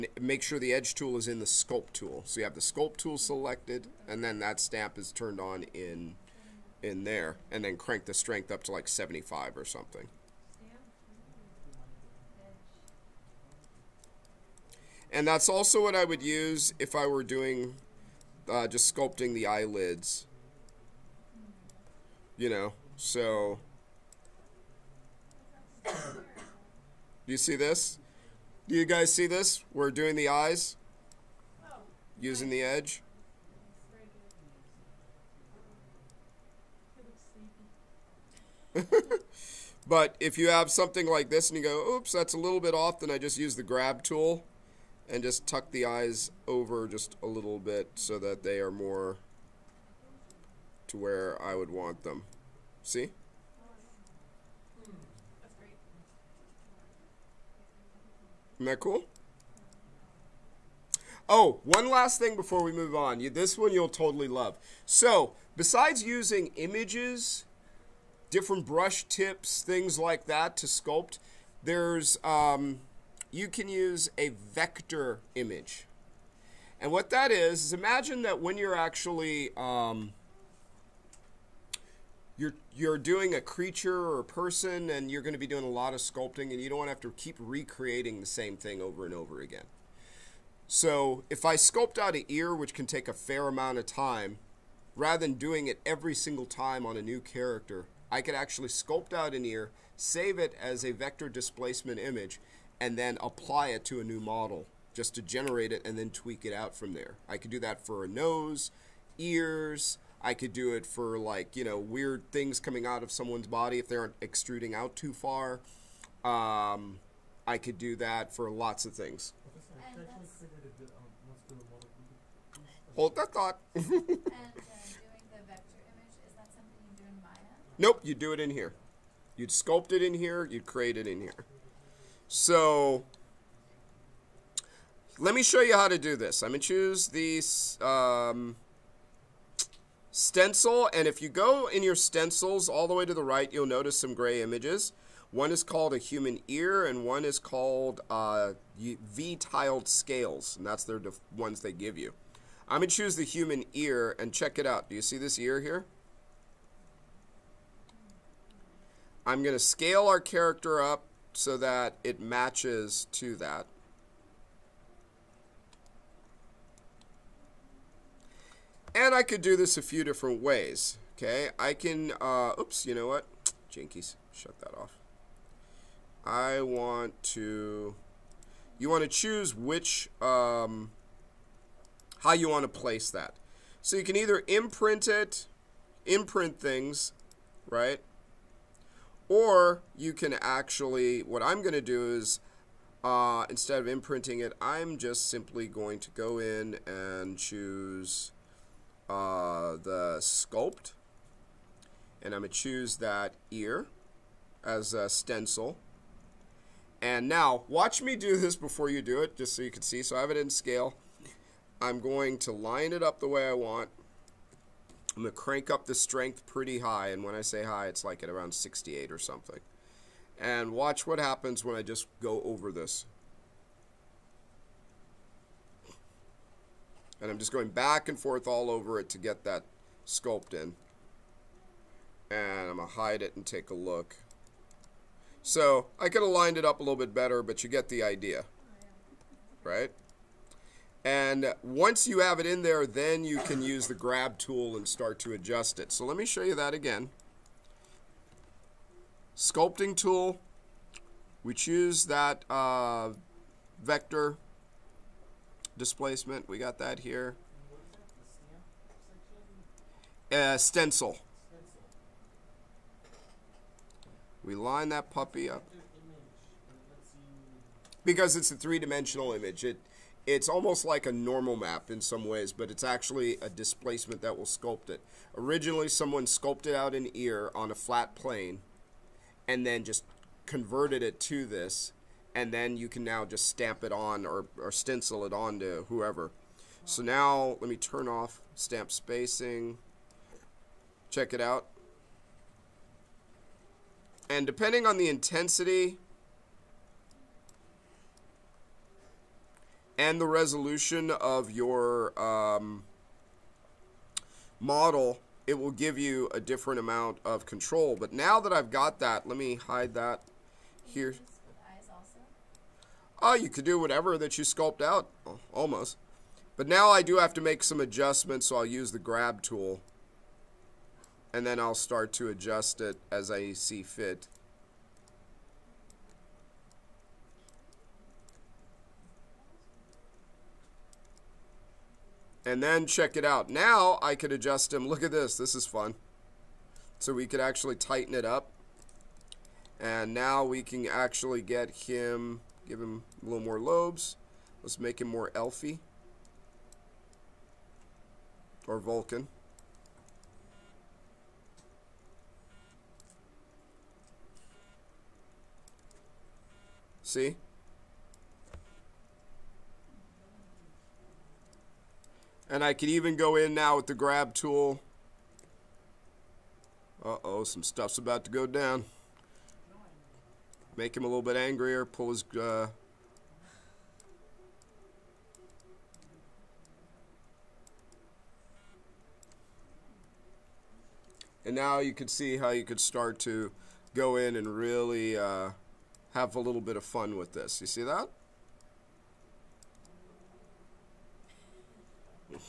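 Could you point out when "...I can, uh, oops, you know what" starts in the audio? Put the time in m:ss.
2:51.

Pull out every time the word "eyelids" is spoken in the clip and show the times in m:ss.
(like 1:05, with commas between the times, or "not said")
0:19.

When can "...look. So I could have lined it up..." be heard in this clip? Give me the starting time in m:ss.
3:53.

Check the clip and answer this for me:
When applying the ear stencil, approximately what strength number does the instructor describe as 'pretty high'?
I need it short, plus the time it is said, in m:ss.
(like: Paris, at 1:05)
68, at 3:38.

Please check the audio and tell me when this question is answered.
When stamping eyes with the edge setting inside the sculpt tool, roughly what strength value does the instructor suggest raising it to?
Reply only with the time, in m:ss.
0:08.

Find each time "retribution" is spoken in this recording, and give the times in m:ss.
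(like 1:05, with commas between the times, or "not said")
not said.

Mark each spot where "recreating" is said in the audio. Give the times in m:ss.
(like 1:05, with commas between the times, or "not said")
1:27.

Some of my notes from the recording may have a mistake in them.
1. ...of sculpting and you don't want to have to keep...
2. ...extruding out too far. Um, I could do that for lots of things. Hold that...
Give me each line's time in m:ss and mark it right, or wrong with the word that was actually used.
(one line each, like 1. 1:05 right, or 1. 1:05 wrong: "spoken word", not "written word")
1. 1:25 right
2. 1:54 right.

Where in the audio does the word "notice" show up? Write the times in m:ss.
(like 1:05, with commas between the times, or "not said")
2:23.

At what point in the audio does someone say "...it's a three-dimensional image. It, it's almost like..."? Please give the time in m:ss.
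4:28.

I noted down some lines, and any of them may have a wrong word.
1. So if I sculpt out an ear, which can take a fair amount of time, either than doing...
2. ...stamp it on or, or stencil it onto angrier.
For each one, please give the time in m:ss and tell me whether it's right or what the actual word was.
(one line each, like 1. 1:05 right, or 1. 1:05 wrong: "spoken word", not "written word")
1. 1:30 wrong: "rather", not "either"
2. 4:43 wrong: "whoever", not "angrier".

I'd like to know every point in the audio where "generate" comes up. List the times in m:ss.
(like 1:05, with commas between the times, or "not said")
1:45.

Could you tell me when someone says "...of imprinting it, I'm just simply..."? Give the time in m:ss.
3:13.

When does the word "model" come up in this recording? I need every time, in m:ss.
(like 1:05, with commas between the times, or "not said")
1:44, 5:04.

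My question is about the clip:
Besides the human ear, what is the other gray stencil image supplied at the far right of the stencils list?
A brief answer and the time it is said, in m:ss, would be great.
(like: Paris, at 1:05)
V-tiled scales, at 2:28.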